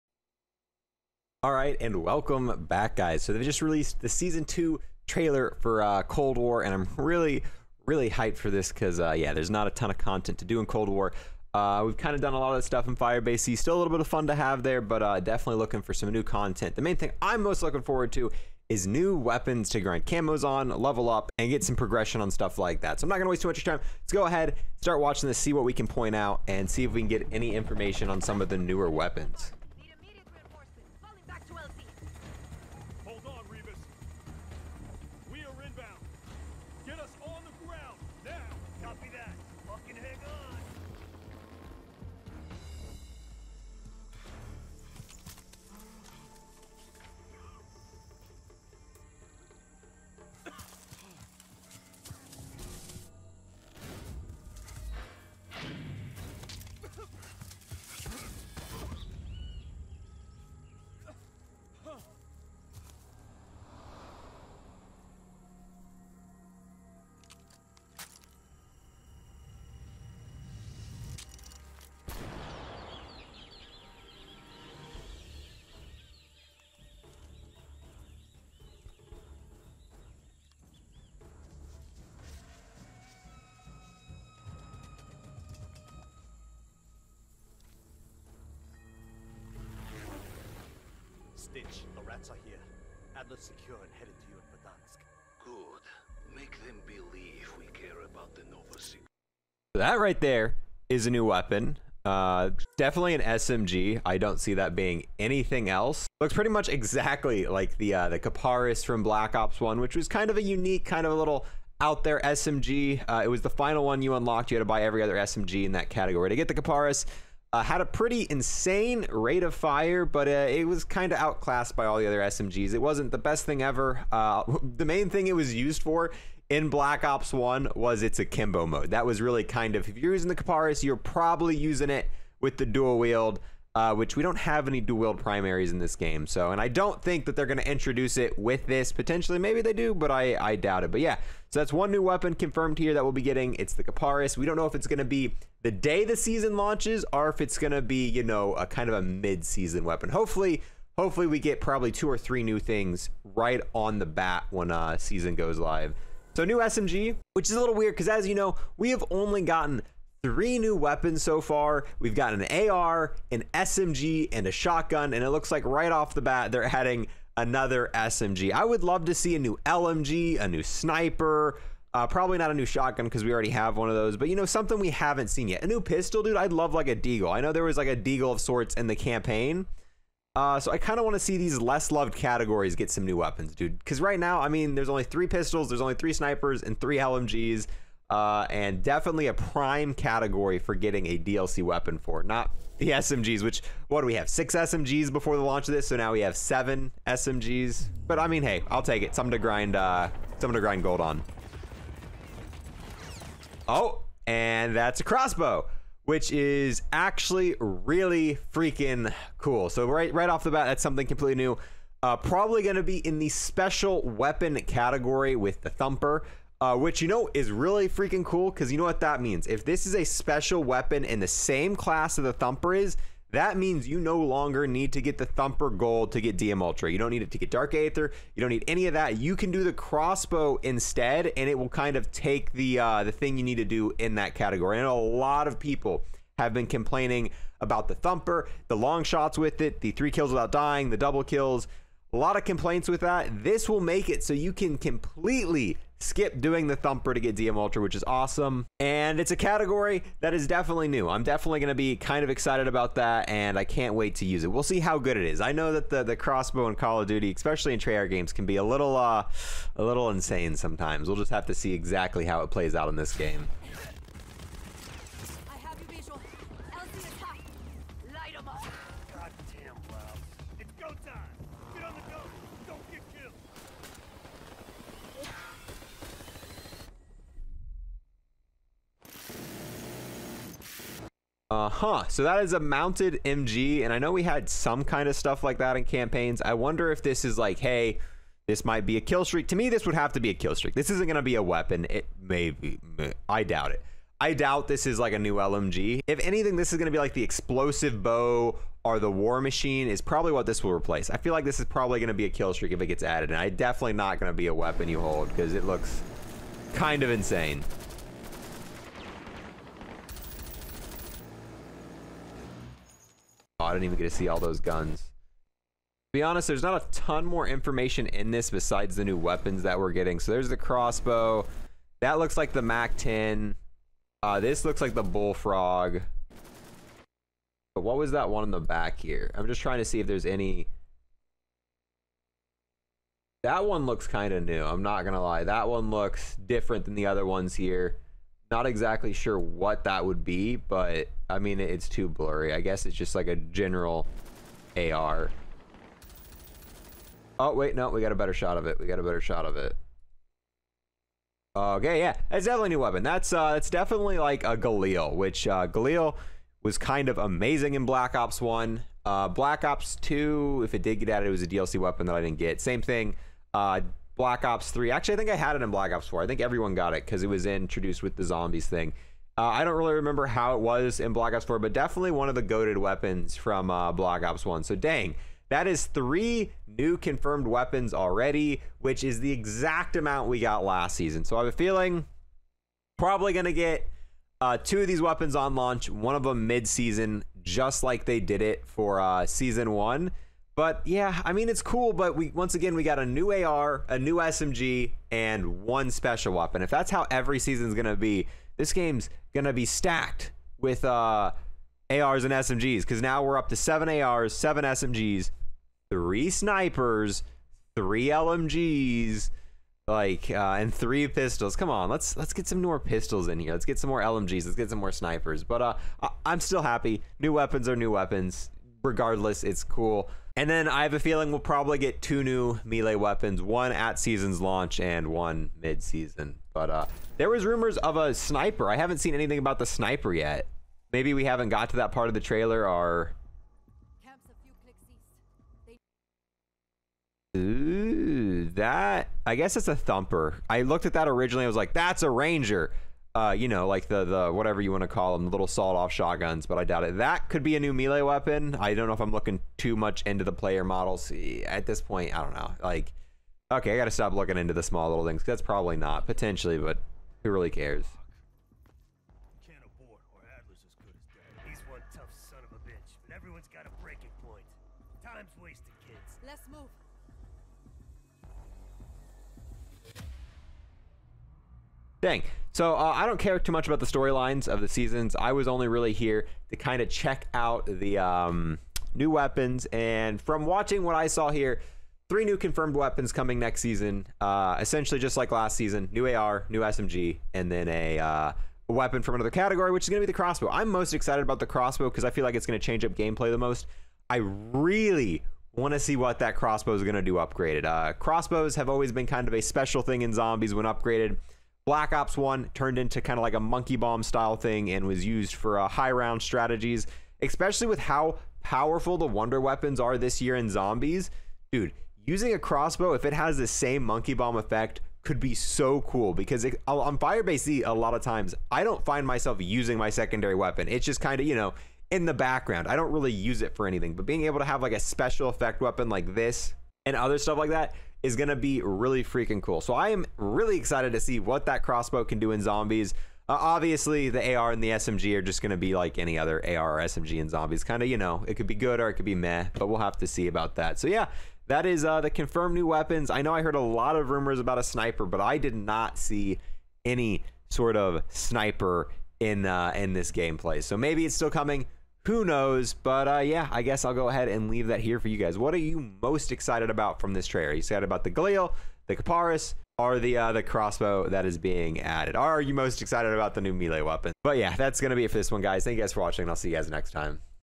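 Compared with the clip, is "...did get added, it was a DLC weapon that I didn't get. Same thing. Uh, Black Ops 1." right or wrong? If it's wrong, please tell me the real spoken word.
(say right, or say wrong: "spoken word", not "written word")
wrong: "3", not "1".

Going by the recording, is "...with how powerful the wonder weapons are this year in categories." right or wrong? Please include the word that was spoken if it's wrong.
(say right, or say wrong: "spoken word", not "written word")
wrong: "zombies", not "categories".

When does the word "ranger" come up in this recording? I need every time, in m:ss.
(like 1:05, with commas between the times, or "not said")
7:22.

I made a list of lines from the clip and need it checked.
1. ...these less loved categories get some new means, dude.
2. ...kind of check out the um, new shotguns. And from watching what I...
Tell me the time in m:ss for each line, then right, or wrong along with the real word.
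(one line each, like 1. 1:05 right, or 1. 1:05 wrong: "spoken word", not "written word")
1. 3:01 wrong: "weapons", not "means"
2. 7:56 wrong: "weapons", not "shotguns".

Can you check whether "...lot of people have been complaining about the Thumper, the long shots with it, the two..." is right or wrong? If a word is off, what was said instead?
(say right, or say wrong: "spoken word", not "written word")
wrong: "three", not "two".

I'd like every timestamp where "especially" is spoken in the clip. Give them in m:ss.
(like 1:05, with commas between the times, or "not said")
4:17, 8:27.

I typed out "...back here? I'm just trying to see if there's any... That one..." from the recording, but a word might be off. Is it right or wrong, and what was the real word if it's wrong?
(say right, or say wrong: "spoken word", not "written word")
right.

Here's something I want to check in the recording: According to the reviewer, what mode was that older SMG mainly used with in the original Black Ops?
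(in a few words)
akimbo.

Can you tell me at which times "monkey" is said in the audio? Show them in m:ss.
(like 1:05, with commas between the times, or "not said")
8:23, 8:33.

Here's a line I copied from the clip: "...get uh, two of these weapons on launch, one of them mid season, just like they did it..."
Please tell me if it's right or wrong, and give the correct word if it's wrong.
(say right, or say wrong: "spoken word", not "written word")
right.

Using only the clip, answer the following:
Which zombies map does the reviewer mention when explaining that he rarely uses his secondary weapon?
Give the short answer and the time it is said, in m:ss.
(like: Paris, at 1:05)
Firebase Z, at 8:36.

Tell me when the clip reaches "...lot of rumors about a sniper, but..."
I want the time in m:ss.
9:03.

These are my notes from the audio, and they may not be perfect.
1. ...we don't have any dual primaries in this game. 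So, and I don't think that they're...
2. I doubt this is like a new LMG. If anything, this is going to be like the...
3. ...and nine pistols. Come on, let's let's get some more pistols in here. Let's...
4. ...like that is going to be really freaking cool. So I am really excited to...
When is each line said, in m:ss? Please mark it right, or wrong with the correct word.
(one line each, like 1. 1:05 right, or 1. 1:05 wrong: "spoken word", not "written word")
1. 2:14 right
2. 4:54 right
3. 6:50 wrong: "three", not "nine"
4. 8:47 right.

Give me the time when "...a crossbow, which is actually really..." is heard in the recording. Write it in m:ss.
3:24.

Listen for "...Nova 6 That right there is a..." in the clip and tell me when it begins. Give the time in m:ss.
1:38.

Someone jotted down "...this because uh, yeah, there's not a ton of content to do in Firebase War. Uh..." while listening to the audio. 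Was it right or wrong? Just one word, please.
wrong.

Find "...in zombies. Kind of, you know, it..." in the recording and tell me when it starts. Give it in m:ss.
8:57.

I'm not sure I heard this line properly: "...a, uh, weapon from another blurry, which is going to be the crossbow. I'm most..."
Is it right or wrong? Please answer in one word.
wrong.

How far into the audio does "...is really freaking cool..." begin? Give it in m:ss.
3:37.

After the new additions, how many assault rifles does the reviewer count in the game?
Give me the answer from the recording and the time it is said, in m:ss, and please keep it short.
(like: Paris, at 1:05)
7, at 6:43.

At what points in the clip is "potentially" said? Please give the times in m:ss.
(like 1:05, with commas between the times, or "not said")
2:18, 7:36.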